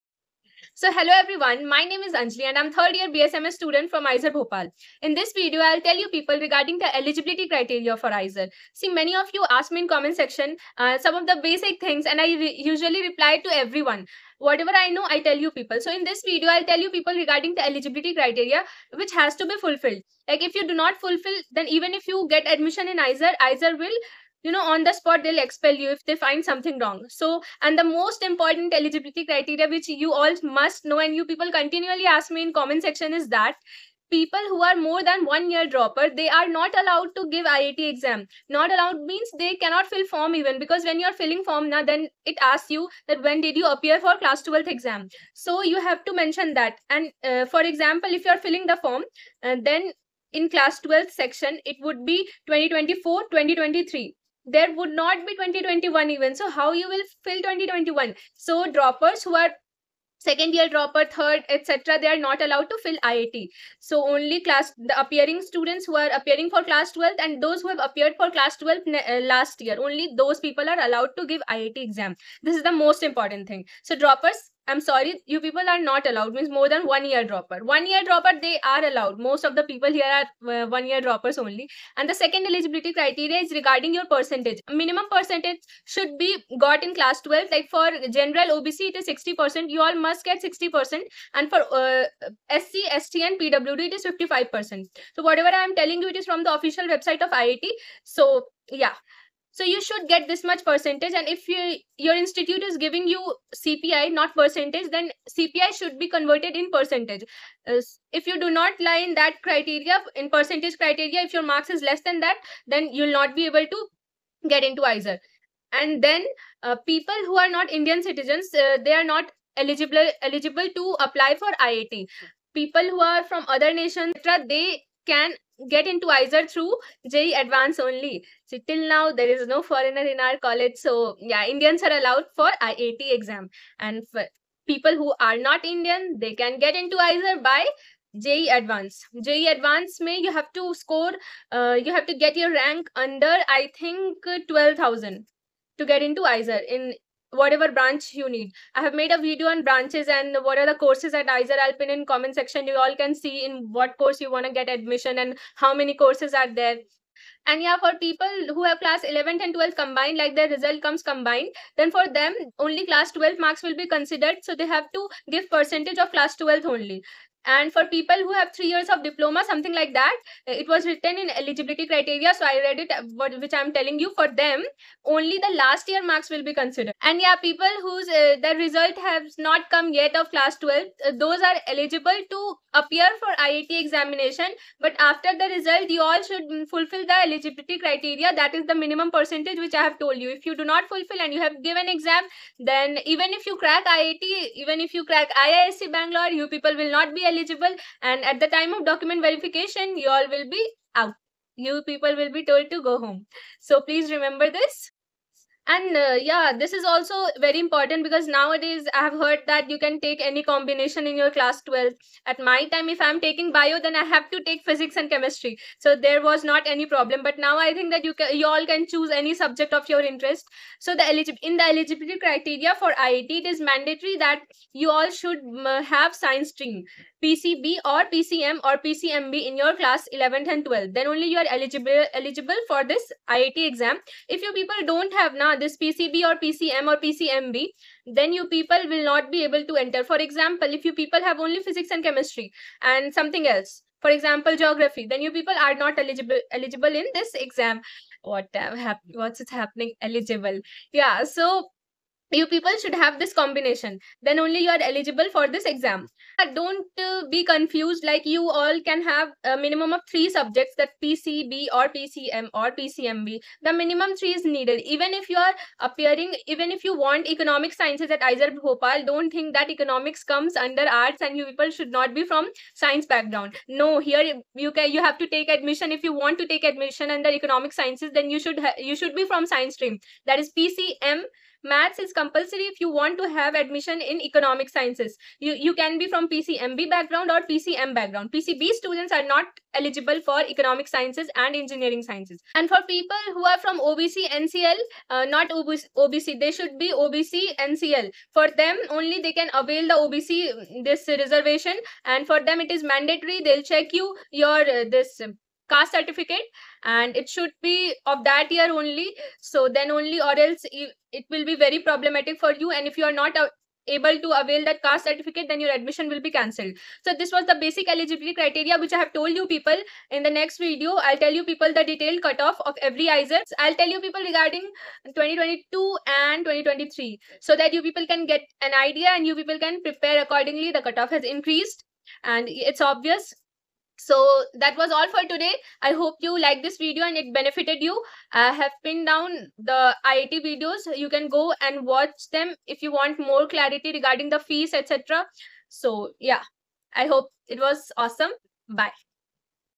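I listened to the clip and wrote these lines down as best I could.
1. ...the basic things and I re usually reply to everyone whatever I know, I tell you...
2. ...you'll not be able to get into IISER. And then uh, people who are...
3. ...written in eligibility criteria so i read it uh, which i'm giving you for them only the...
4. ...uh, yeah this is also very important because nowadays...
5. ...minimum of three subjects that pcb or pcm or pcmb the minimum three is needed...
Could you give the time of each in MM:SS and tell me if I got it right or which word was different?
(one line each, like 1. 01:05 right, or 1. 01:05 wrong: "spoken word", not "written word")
1. 00:11 right
2. 01:52 right
3. 02:50 wrong: "telling", not "giving"
4. 03:25 right
5. 04:19 right.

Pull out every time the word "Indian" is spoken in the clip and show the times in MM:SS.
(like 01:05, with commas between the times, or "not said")
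01:57, 02:11, 02:15.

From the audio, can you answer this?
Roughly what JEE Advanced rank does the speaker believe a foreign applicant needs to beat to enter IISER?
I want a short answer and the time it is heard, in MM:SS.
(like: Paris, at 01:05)
12,000, at 02:24.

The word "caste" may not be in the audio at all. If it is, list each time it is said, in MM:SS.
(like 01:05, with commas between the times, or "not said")
05:05, 05:14.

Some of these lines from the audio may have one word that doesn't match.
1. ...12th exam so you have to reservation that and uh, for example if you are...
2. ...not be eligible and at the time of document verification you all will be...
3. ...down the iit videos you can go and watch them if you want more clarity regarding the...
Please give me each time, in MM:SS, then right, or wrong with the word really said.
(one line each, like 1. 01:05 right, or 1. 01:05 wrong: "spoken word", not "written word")
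1. 00:44 wrong: "mention", not "reservation"
2. 03:16 right
3. 05:39 right.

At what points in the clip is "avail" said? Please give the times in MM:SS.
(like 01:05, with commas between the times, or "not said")
04:59, 05:14.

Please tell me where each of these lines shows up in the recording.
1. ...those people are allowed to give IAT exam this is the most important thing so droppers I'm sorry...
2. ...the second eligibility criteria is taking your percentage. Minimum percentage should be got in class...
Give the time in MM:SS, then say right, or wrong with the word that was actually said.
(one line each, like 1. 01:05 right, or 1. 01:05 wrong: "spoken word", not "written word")
1. 01:10 right
2. 01:22 wrong: "regarding", not "taking".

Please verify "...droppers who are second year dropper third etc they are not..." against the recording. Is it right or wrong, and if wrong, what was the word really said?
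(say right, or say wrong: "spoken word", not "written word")
right.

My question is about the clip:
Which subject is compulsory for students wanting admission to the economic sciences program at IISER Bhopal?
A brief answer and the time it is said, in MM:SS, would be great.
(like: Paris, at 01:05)
Maths, at 04:41.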